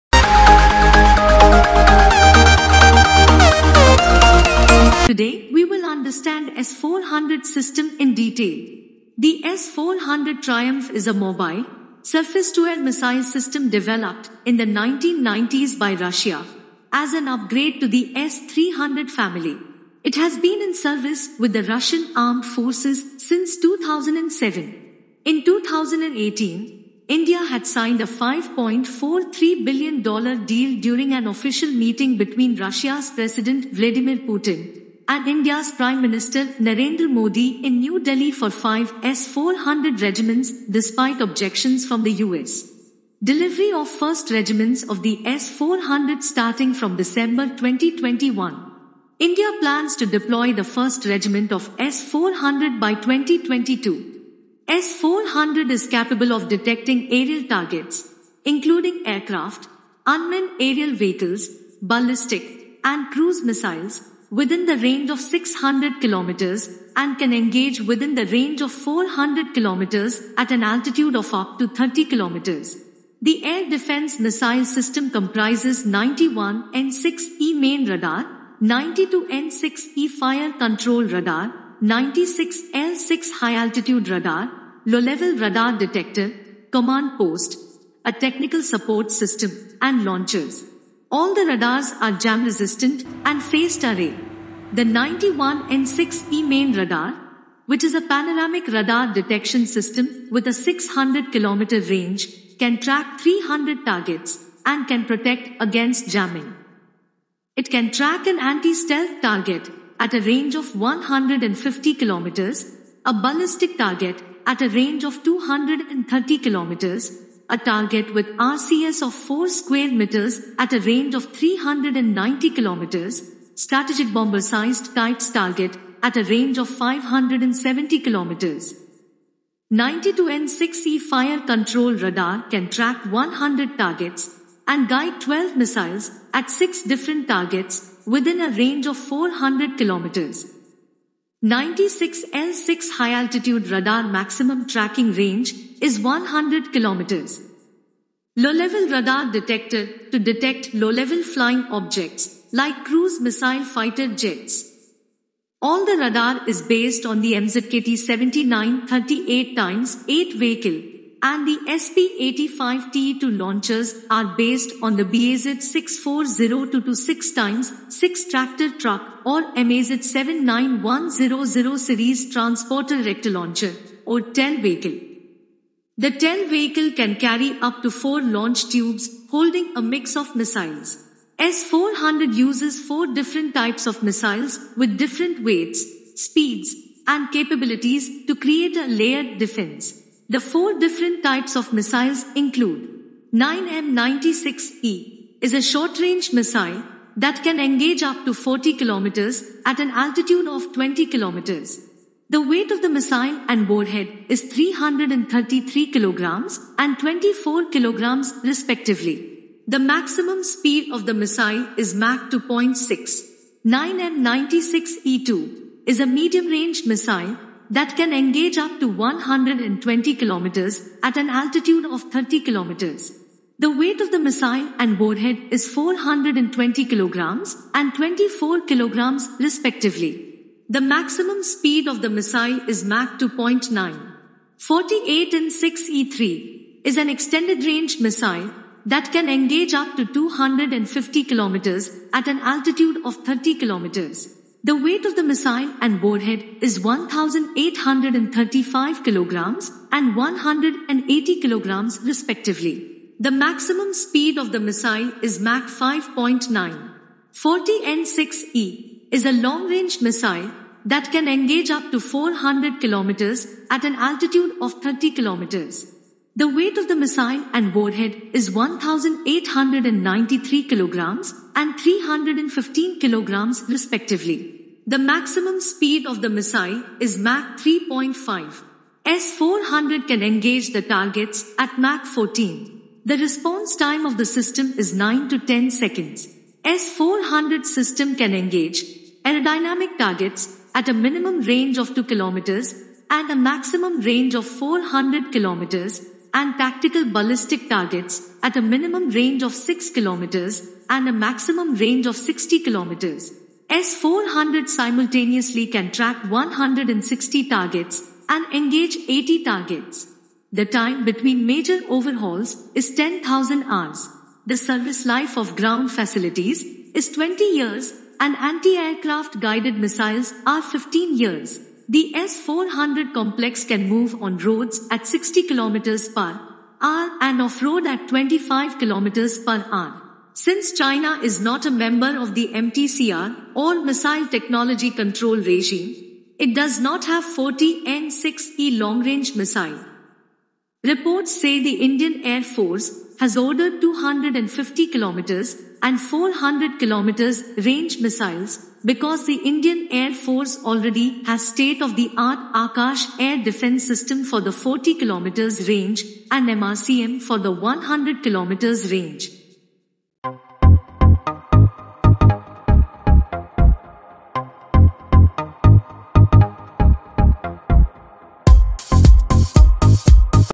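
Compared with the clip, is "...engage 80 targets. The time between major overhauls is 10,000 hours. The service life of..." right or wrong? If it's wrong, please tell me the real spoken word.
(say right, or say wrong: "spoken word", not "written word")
right.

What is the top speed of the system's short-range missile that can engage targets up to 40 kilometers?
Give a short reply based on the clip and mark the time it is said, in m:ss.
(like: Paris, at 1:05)
Mach 2.6, at 3:31.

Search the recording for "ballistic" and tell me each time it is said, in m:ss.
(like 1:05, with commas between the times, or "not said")
1:01, 1:53, 4:57.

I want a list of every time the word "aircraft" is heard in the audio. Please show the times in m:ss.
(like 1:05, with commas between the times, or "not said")
0:59, 5:18.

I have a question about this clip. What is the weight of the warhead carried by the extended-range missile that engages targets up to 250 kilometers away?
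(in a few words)
180 kilograms.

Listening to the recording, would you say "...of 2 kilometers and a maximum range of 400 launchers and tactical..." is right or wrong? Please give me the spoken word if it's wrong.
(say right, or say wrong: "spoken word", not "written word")
wrong: "kilometers", not "launchers".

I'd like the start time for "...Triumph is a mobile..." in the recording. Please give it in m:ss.
0:10.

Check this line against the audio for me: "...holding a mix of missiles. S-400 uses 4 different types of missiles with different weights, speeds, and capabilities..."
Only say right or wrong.
right.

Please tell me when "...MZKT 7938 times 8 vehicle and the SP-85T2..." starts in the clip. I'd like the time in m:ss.
2:37.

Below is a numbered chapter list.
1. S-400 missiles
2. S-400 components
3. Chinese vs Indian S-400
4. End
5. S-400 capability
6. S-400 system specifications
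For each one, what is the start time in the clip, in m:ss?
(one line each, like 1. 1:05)
1. 3:01
2. 1:13
3. 5:30
4. 6:00
5. 0:54
6. 4:39.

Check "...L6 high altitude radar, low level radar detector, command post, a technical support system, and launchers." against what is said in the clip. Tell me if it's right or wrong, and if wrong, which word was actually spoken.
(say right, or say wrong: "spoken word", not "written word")
right.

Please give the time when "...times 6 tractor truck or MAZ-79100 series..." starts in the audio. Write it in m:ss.
2:47.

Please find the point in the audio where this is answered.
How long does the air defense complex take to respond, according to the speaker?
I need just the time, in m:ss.
4:44.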